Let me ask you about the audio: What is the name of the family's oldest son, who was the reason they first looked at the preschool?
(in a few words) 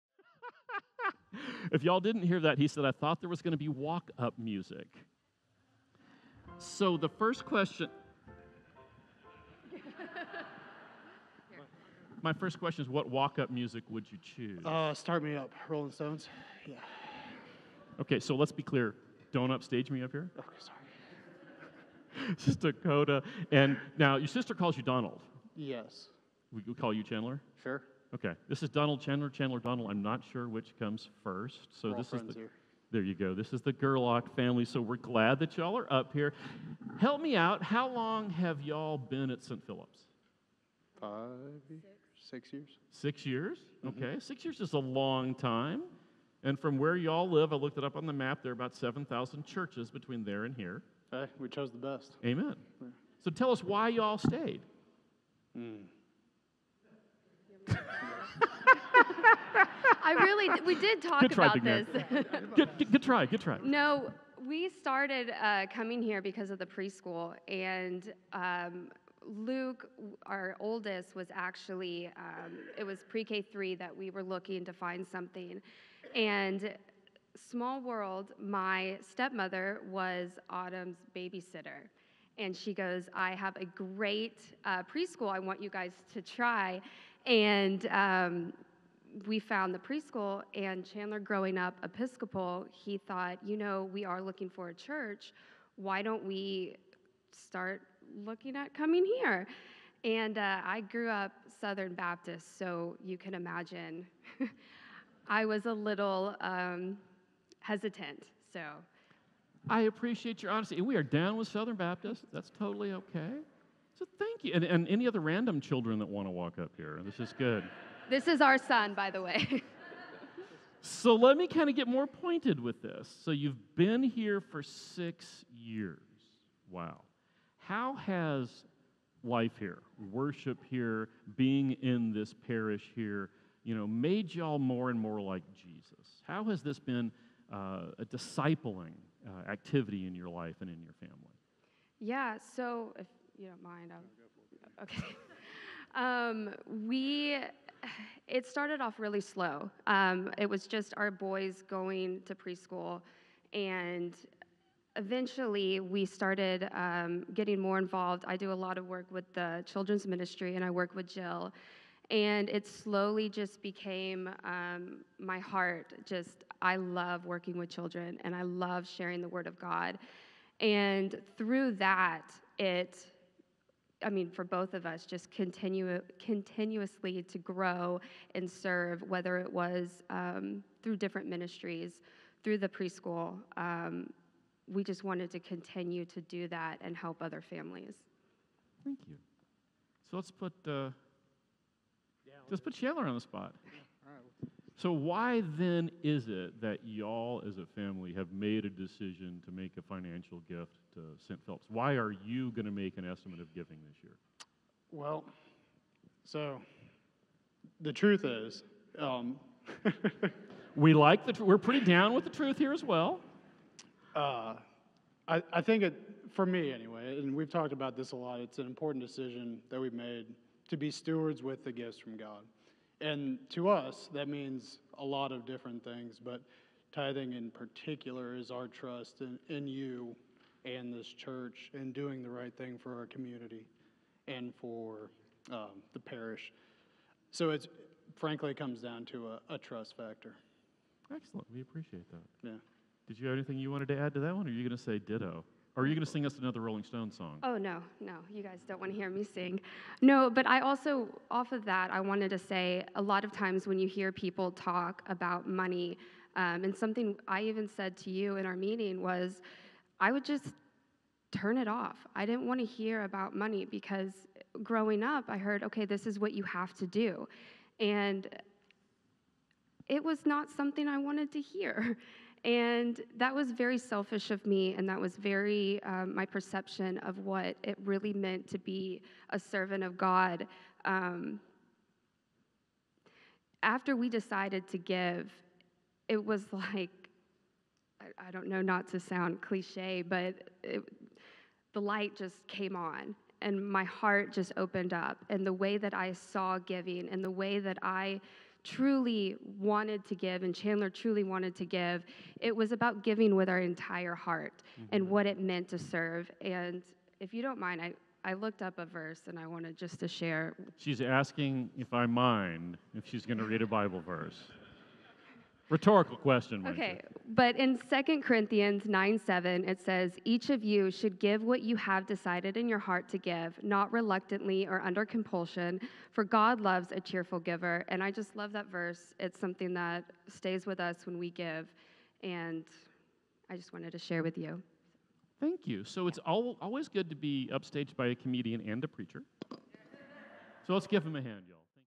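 Luke.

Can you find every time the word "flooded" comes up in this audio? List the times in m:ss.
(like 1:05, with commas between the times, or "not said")
not said.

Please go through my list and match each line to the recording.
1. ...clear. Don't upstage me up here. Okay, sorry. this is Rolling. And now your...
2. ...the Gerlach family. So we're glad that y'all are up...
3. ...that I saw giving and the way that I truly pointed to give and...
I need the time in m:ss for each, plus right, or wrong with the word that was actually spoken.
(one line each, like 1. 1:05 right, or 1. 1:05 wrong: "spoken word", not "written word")
1. 0:18 wrong: "Dakota", not "Rolling"
2. 0:33 right
3. 4:55 wrong: "wanted", not "pointed".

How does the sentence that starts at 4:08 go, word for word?
You guys don't want to hear me sing.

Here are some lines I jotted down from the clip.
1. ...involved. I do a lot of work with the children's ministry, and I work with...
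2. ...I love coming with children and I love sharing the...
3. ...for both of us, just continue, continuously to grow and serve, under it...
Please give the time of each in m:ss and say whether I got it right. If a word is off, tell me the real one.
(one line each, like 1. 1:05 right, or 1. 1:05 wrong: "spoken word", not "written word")
1. 2:37 right
2. 2:46 wrong: "working", not "coming"
3. 2:54 wrong: "whether", not "under".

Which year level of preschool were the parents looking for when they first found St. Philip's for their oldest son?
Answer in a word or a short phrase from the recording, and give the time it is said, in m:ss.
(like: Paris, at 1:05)
pre K 3, at 1:13.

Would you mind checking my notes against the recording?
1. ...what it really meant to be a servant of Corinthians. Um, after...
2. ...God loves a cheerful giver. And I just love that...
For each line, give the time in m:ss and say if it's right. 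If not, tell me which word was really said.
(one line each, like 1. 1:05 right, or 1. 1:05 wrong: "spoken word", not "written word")
1. 4:37 wrong: "God", not "Corinthians"
2. 5:26 right.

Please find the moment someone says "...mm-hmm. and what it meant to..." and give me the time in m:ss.
5:04.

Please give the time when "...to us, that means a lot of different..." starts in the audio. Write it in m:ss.
3:43.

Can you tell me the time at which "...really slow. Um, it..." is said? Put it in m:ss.
2:28.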